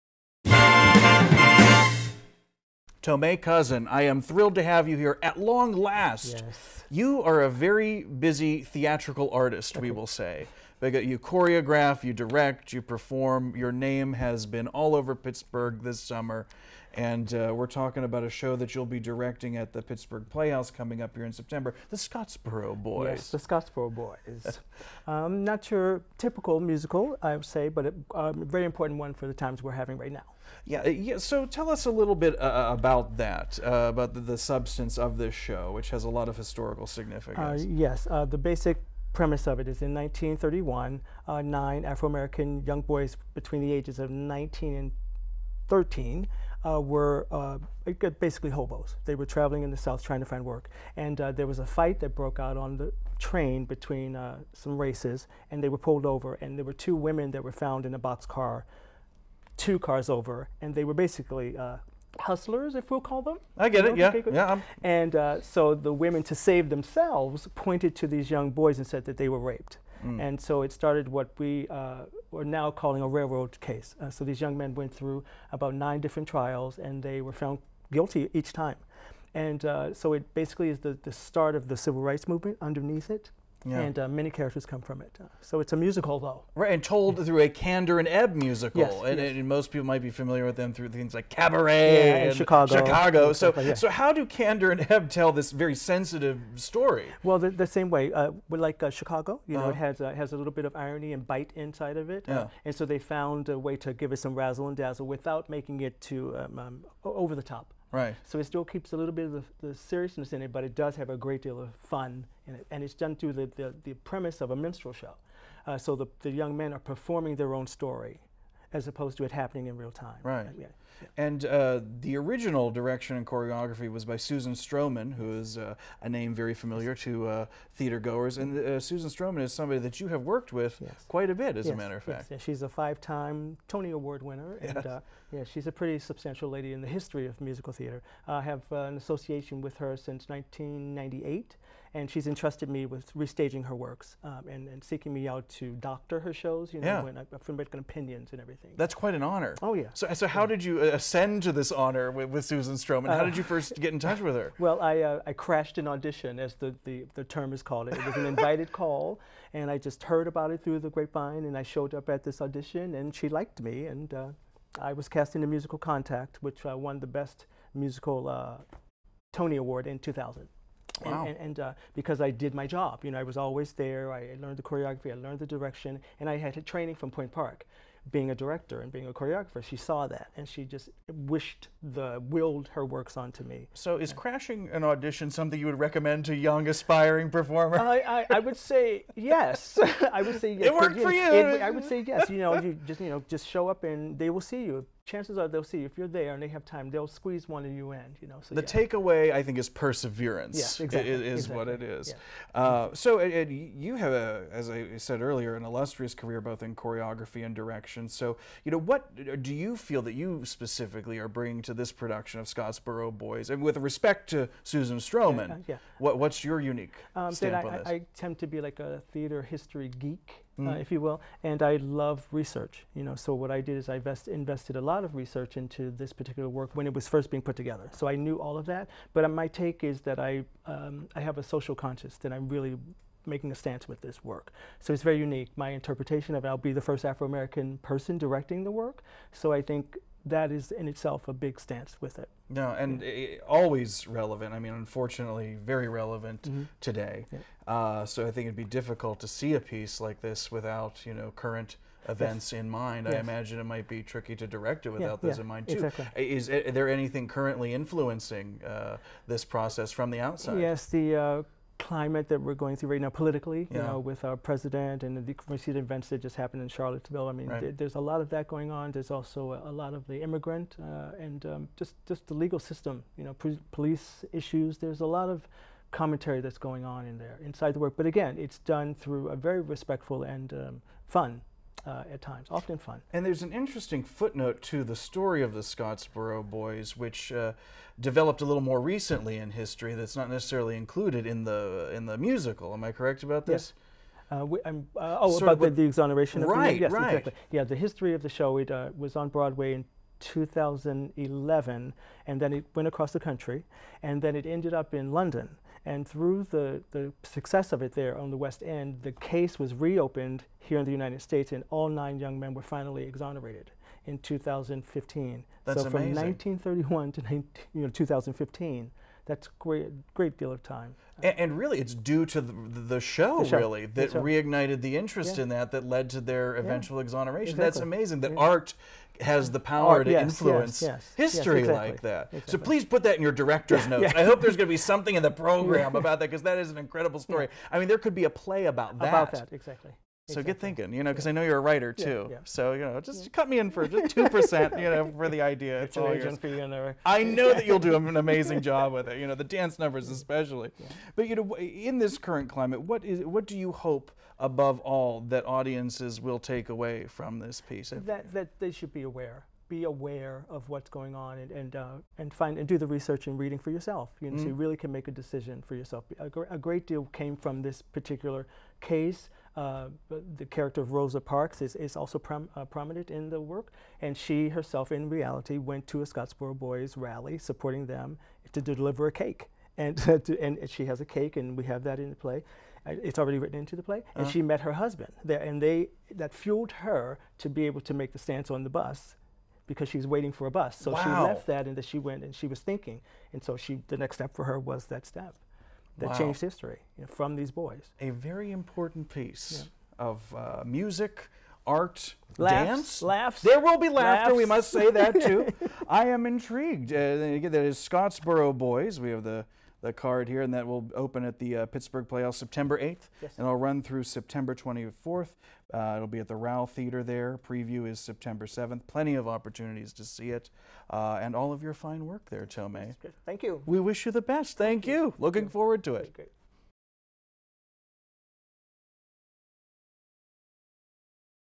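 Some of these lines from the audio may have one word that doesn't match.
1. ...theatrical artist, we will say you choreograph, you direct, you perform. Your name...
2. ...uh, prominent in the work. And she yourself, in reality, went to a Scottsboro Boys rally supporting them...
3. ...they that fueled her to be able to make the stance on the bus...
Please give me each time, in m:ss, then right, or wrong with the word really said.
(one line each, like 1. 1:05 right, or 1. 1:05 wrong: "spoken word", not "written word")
1. 0:08 right
2. 6:12 wrong: "herself", not "yourself"
3. 6:25 right.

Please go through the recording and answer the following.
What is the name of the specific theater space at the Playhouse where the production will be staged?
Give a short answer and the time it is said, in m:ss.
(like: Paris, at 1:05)
Rauh Theater, at 6:56.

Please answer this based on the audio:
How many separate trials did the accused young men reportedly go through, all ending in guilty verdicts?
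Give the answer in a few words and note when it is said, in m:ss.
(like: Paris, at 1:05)
9, at 1:15.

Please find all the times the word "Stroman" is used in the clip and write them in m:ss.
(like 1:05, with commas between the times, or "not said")
2:04, 2:09, 2:32, 3:34.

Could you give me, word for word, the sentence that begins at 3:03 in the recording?
So, is crashing an audition something you would recommend to young aspiring performer?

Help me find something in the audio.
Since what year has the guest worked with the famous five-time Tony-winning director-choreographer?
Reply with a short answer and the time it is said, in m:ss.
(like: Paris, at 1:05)
1998, at 2:20.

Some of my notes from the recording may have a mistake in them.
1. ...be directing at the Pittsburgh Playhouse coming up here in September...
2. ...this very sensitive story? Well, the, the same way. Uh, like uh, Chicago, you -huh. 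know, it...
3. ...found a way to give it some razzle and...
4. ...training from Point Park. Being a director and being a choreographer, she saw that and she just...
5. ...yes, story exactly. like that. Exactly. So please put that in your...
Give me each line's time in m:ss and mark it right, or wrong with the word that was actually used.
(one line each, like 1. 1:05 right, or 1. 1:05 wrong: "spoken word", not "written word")
1. 0:18 right
2. 1:35 right
3. 1:42 right
4. 2:56 right
5. 5:31 wrong: "history", not "story".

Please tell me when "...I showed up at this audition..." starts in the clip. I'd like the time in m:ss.
2:41.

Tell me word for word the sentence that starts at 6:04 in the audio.
really can make a decision for yourself.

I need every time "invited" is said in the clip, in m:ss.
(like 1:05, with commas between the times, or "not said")
2:38.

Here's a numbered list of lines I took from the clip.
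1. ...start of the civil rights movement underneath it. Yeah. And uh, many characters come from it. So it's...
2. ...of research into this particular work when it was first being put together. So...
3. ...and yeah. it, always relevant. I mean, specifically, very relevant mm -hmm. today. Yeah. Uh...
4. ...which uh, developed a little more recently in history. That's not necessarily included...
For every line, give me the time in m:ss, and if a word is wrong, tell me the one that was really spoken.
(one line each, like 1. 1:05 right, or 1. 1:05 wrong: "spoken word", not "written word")
1. 1:21 right
2. 3:45 right
3. 4:02 wrong: "unfortunately", not "specifically"
4. 4:46 right.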